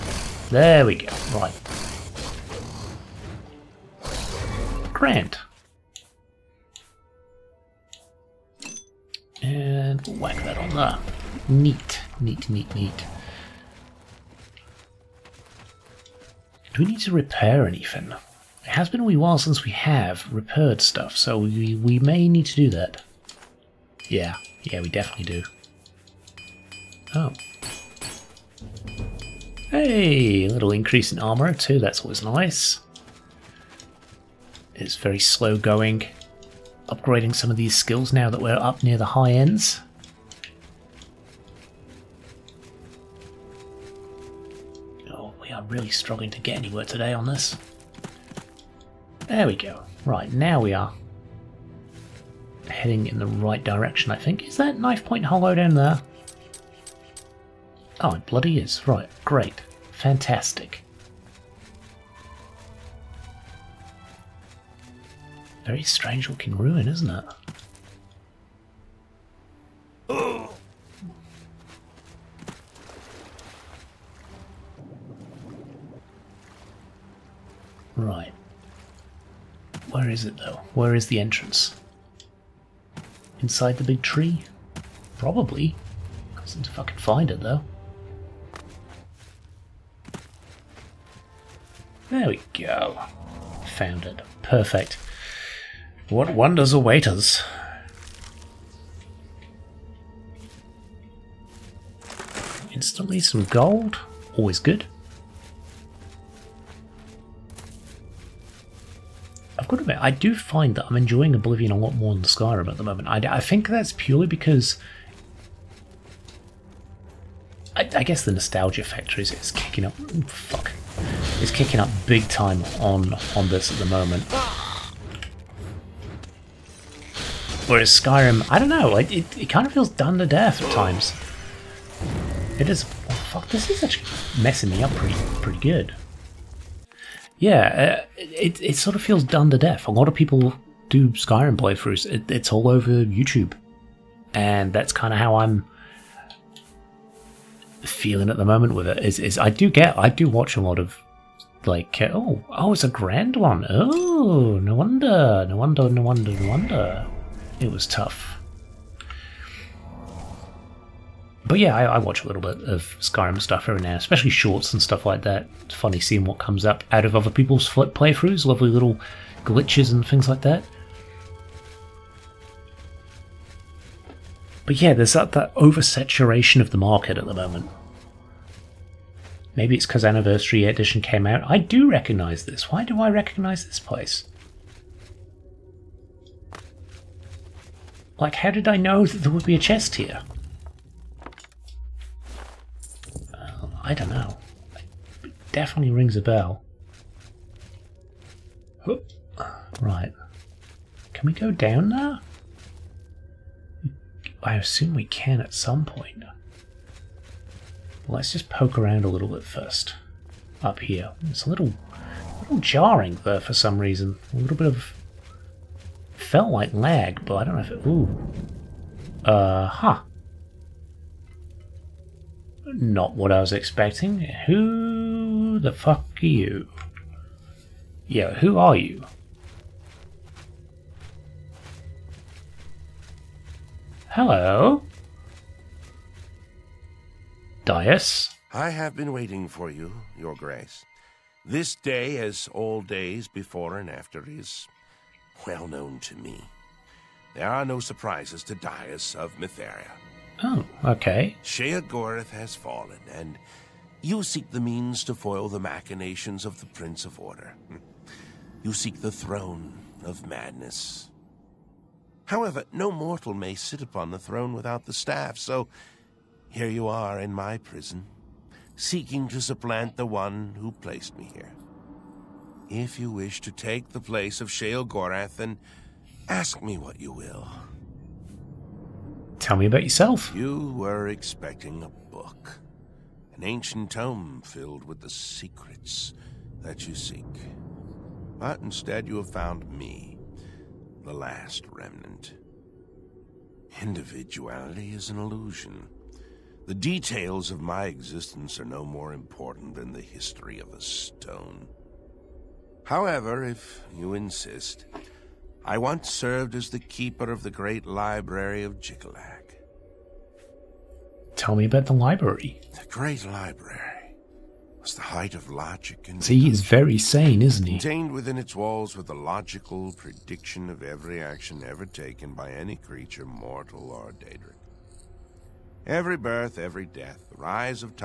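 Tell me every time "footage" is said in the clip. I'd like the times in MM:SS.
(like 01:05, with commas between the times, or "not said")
not said.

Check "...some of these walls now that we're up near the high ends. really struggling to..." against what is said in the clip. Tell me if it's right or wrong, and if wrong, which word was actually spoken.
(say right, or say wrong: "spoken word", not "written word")
wrong: "skills", not "walls".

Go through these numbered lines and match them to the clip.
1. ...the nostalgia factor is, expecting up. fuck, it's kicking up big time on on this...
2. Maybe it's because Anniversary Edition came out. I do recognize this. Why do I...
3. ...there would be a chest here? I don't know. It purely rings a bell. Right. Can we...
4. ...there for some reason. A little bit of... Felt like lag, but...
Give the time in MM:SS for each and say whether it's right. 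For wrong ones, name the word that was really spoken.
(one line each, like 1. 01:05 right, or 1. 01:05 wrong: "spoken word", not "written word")
1. 01:58 wrong: "kicking", not "expecting"
2. 02:59 right
3. 03:09 wrong: "definitely", not "purely"
4. 03:33 right.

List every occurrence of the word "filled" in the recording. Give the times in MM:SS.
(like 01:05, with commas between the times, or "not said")
04:44.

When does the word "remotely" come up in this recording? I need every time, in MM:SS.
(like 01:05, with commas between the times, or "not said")
not said.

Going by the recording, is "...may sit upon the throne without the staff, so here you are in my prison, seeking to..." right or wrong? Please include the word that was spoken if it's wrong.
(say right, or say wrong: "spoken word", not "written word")
right.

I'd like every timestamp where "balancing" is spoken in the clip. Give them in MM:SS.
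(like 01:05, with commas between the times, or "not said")
not said.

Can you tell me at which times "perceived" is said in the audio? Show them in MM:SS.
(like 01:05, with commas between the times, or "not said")
not said.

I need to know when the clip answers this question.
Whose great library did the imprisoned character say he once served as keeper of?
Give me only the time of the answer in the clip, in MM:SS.
05:08.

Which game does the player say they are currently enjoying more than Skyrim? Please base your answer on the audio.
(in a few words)
Oblivion.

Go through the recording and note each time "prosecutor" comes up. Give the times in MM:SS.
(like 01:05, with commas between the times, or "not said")
not said.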